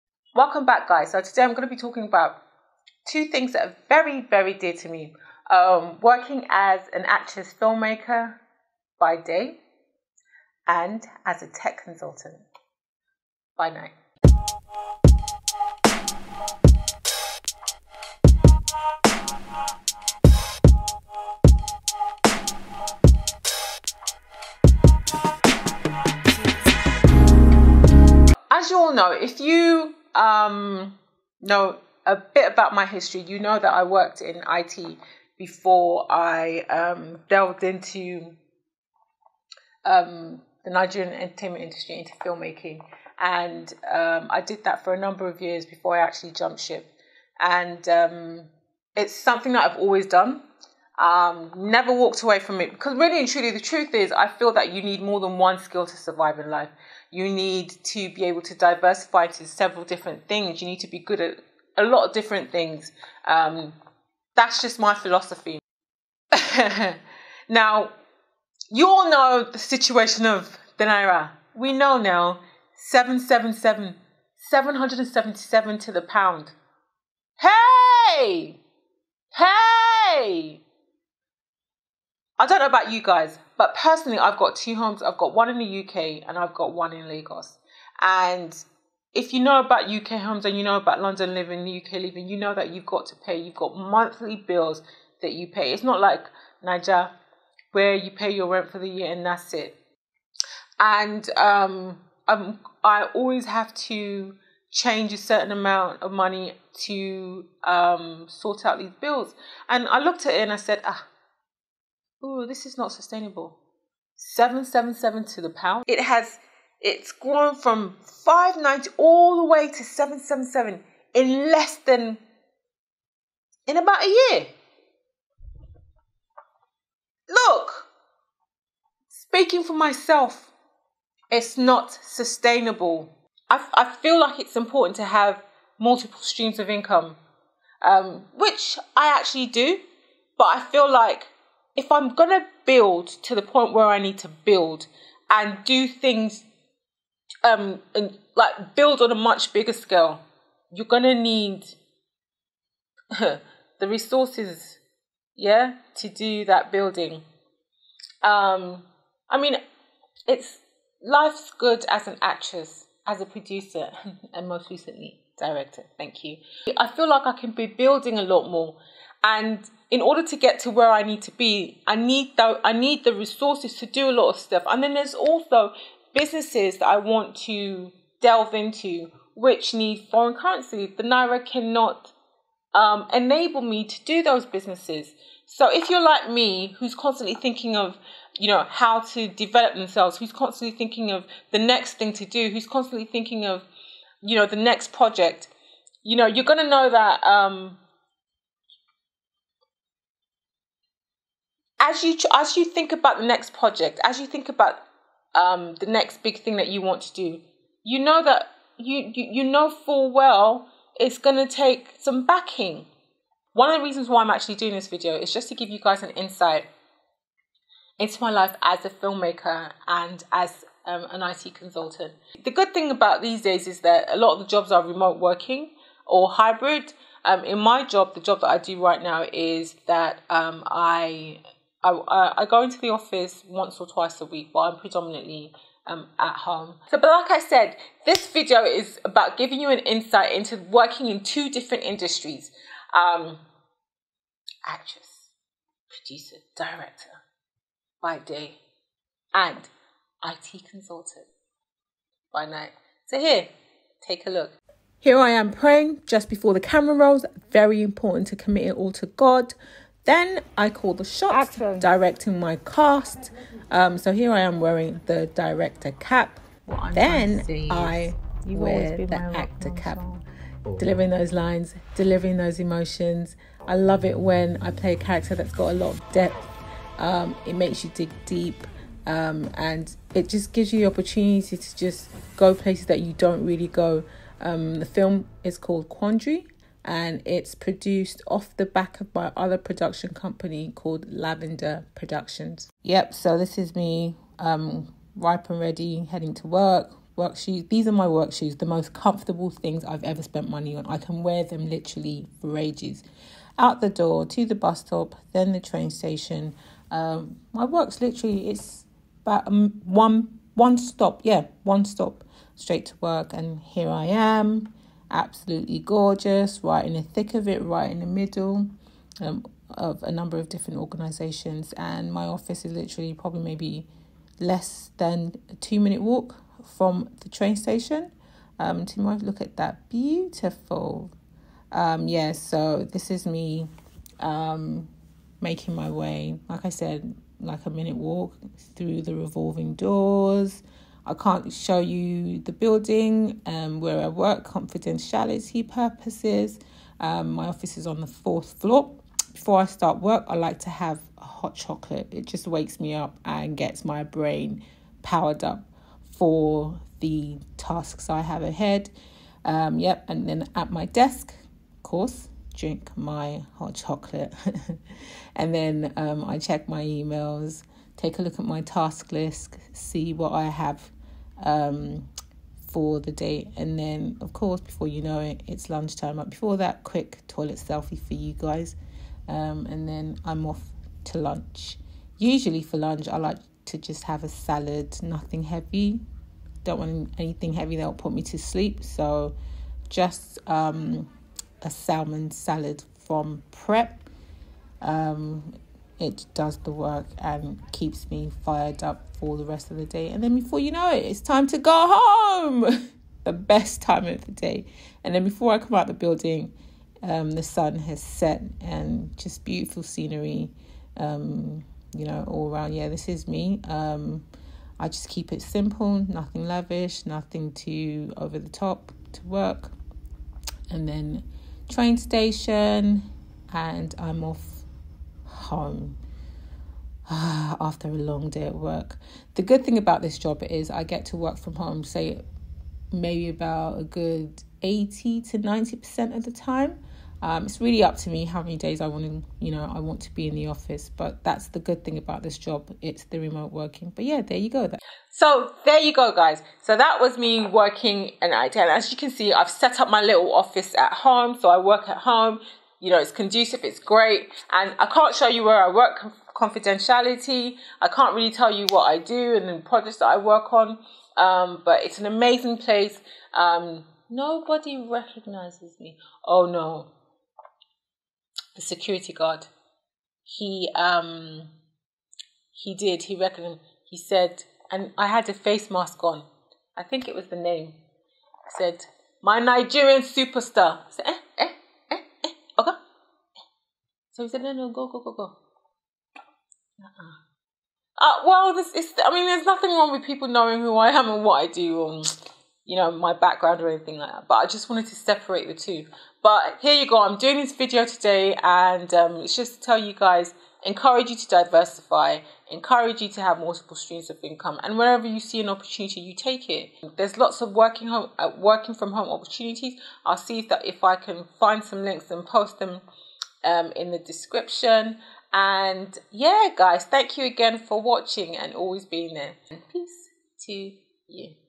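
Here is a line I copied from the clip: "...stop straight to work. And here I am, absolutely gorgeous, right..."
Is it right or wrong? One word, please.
right.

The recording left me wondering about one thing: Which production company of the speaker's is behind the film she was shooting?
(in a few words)
Lavender Productions.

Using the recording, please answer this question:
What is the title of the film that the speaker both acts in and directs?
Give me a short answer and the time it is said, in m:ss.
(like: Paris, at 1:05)
Quandary, at 4:45.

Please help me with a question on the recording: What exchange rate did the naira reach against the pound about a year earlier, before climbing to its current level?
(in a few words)
590.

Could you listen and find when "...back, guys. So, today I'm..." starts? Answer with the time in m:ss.
0:00.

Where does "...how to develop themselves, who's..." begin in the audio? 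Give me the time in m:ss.
3:08.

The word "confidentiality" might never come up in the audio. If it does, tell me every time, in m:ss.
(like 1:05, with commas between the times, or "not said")
5:44, 7:36.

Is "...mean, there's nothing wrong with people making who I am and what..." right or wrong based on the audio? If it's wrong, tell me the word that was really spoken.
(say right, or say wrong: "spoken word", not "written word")
wrong: "knowing", not "making".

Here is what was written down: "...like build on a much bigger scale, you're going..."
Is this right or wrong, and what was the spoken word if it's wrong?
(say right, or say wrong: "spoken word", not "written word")
right.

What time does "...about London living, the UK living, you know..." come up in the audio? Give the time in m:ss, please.
1:30.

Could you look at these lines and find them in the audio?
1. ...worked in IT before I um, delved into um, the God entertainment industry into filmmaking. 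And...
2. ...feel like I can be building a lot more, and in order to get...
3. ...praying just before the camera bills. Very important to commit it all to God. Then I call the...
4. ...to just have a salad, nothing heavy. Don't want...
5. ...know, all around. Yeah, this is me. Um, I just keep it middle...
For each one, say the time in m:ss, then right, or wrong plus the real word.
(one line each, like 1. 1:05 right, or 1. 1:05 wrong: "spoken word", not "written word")
1. 0:33 wrong: "Nigerian", not "God"
2. 2:46 right
3. 4:15 wrong: "rolls", not "bills"
4. 6:23 right
5. 6:52 wrong: "simple", not "middle".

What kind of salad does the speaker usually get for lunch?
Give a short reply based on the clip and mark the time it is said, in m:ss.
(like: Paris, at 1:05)
salmon salad, at 6:31.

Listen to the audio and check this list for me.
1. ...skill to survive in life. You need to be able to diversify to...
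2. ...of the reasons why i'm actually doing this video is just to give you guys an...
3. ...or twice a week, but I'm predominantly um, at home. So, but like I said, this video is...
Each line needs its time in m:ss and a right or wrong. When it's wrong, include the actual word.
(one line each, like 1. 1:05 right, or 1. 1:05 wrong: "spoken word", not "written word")
1. 0:55 right
2. 3:33 right
3. 3:53 right.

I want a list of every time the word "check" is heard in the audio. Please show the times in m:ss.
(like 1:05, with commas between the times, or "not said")
6:06.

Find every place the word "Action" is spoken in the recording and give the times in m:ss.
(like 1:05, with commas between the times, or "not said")
4:21.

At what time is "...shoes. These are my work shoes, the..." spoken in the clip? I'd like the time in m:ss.
4:57.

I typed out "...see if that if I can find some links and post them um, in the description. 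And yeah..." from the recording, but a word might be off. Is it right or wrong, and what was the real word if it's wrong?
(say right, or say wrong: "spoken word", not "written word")
right.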